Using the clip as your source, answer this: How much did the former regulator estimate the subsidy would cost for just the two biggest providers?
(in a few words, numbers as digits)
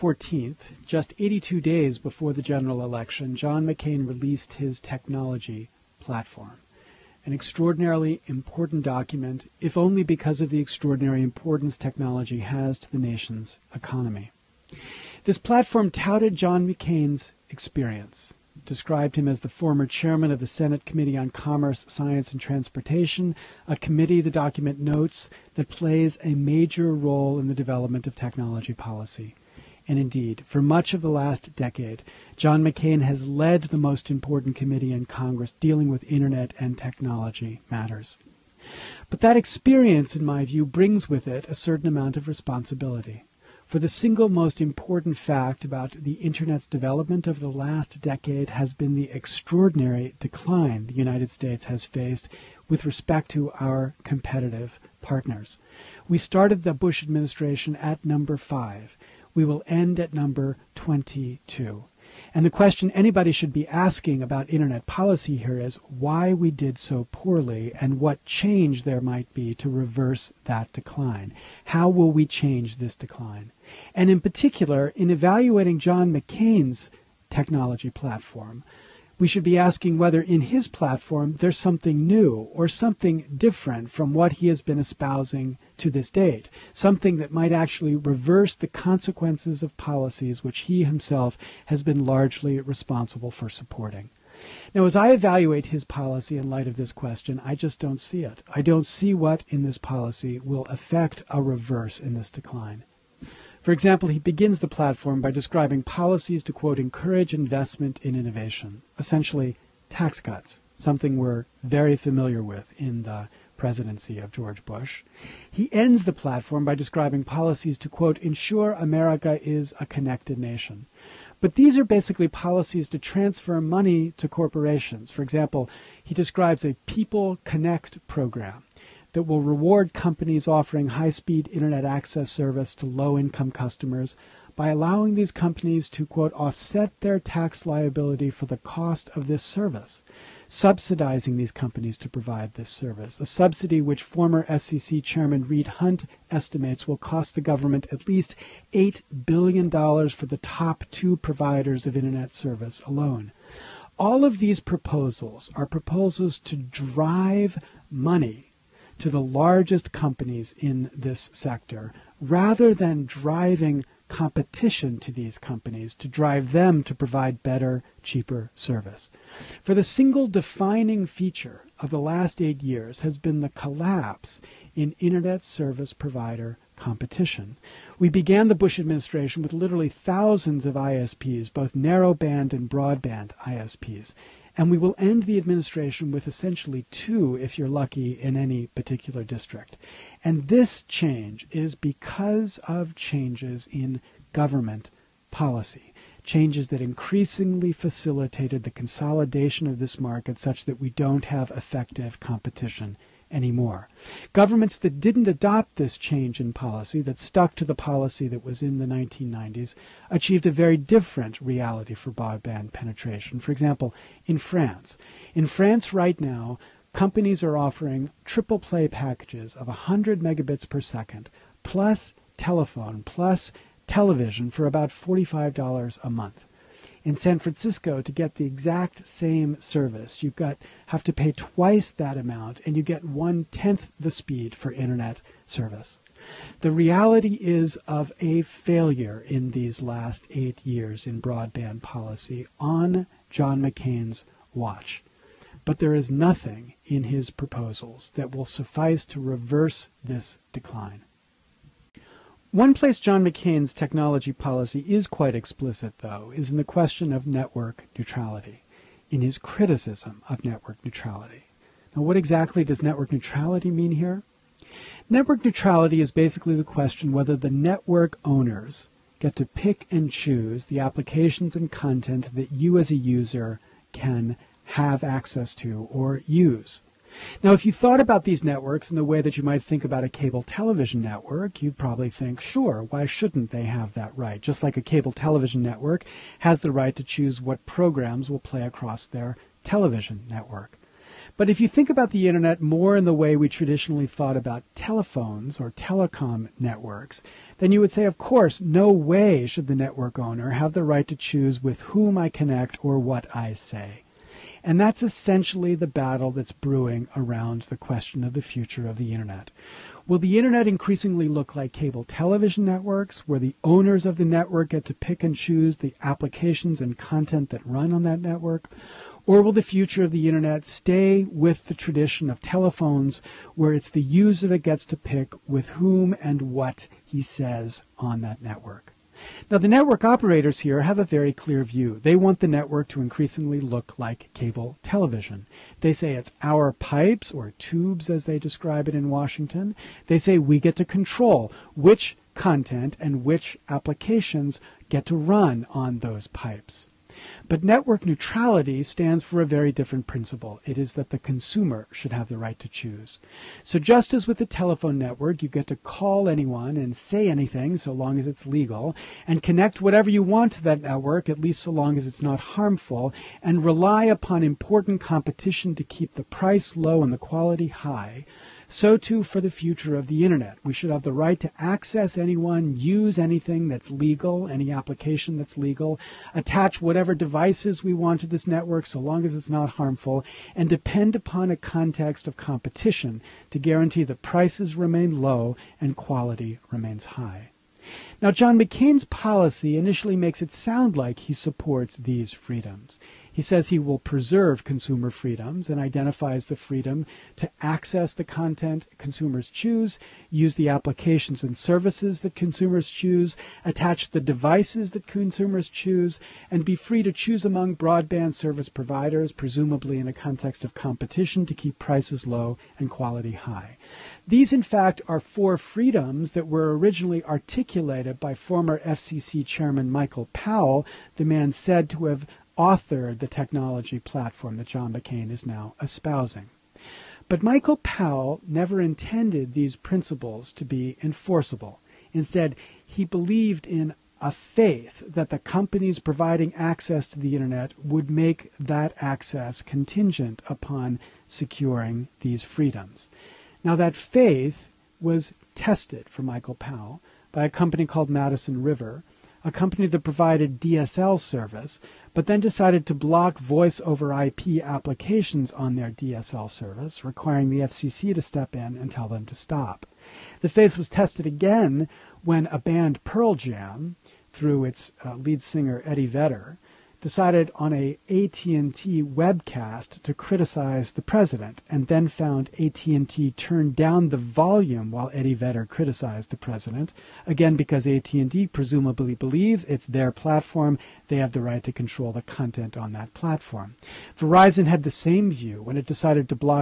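$8 billion.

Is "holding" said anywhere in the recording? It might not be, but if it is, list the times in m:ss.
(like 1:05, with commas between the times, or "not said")
not said.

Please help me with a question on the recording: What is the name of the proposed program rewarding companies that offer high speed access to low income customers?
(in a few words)
People Connect.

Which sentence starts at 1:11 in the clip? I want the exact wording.
How will we change this decline?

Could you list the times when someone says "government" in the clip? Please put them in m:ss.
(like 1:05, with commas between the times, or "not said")
2:27, 3:14, 3:24.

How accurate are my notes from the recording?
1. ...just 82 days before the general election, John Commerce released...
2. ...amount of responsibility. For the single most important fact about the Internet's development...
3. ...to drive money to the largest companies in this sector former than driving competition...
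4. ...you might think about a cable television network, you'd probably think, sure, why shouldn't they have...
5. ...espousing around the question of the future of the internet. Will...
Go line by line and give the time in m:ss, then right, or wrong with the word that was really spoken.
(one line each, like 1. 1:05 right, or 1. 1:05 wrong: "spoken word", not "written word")
1. 0:00 wrong: "McCain", not "Commerce"
2. 0:41 right
3. 2:36 wrong: "rather", not "former"
4. 4:39 right
5. 5:06 wrong: "brewing", not "espousing".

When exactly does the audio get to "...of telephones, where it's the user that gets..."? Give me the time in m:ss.
5:22.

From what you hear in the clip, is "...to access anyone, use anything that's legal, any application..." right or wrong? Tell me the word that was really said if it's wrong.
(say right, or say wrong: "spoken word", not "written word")
right.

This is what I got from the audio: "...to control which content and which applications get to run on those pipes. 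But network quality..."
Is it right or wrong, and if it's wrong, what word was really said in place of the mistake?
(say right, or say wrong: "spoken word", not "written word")
wrong: "neutrality", not "quality".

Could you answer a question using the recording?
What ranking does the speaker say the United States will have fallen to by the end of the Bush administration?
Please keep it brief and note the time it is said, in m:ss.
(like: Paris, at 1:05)
22, at 1:00.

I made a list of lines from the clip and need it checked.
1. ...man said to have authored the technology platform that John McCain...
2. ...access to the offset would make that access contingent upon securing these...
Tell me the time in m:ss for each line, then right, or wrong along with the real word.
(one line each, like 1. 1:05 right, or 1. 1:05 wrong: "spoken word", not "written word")
1. 7:01 right
2. 7:16 wrong: "internet", not "offset".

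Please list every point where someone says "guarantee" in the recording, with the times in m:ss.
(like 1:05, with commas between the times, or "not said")
6:23.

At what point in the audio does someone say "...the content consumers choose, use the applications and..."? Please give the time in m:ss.
6:38.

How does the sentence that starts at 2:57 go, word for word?
We began the Bush administration with literally thousands of ISPs, both narrowband and broadband ISPs.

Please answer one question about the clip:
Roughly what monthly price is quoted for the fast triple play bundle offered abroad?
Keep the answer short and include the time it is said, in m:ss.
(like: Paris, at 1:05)
$45, at 3:44.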